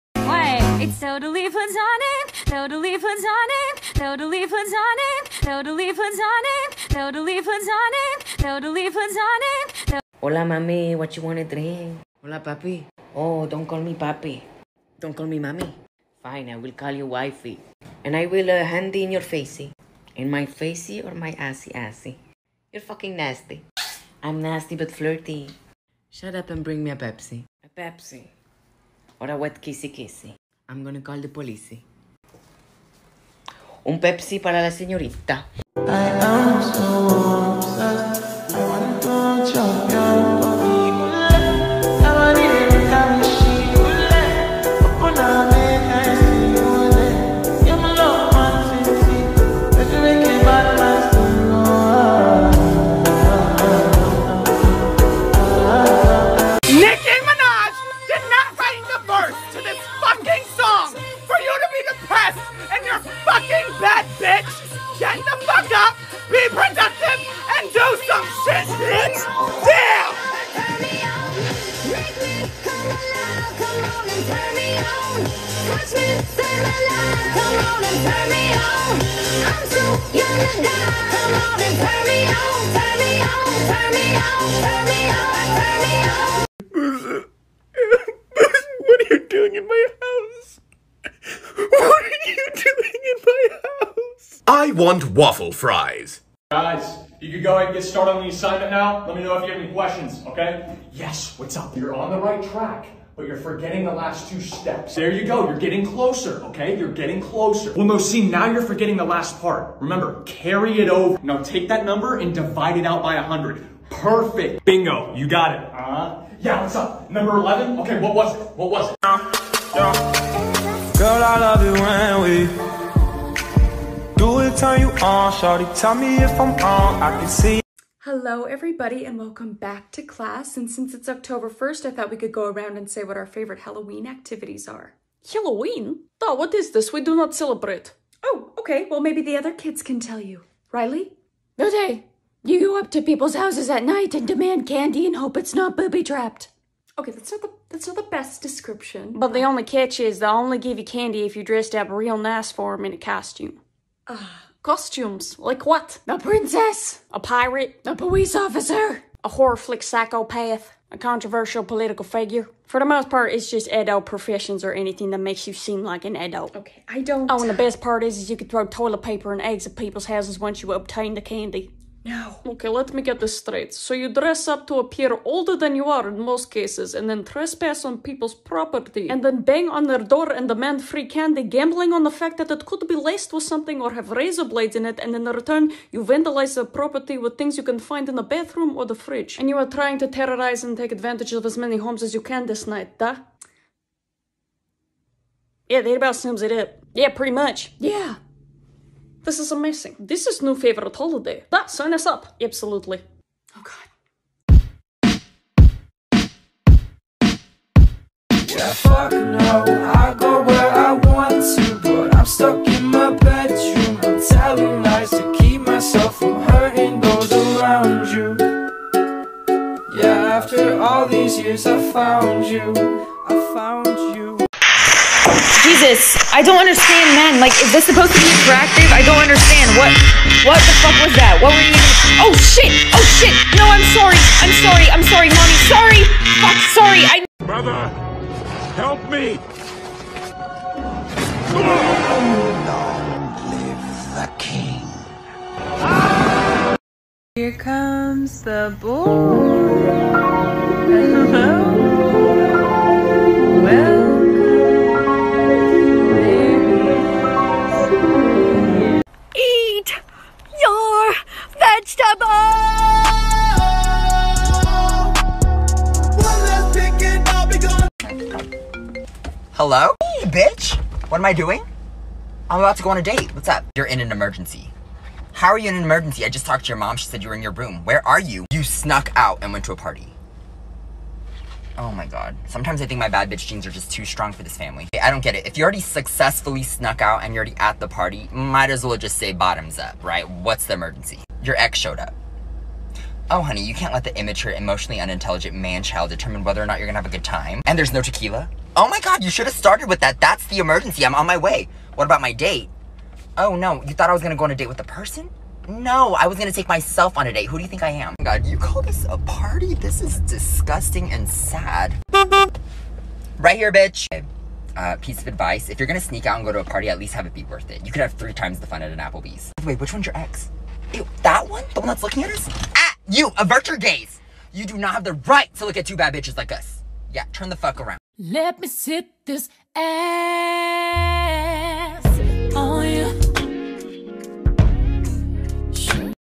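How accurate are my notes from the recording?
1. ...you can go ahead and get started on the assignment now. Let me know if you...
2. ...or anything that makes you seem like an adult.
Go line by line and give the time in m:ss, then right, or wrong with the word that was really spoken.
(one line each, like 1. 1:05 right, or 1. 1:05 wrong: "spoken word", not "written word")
1. 1:37 right
2. 2:44 right.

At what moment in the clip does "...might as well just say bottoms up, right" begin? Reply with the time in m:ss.
4:48.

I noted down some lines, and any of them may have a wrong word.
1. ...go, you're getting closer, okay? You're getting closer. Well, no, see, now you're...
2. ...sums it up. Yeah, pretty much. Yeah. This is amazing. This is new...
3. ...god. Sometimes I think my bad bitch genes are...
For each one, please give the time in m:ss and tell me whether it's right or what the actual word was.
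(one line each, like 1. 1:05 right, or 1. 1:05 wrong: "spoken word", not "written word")
1. 1:45 right
2. 3:16 right
3. 4:42 right.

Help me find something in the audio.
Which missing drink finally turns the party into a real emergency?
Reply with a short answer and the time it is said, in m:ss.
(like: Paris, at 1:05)
Tequila, at 4:58.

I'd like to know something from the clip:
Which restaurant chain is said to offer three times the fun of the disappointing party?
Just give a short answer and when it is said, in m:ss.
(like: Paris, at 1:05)
Applebee's, at 5:18.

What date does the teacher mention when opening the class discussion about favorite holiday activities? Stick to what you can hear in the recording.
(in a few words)
October 1st.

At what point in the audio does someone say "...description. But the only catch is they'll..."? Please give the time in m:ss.
2:28.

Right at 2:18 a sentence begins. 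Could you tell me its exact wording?
Well, maybe the other kids can tell you.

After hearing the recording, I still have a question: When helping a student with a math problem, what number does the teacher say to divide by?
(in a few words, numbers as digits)
100.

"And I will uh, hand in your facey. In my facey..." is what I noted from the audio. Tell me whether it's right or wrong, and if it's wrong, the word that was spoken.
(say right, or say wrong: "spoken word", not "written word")
right.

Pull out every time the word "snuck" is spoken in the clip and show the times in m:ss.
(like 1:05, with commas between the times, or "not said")
4:38, 4:46.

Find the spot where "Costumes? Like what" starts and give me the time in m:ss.
2:34.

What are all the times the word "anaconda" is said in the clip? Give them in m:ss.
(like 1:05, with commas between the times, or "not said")
not said.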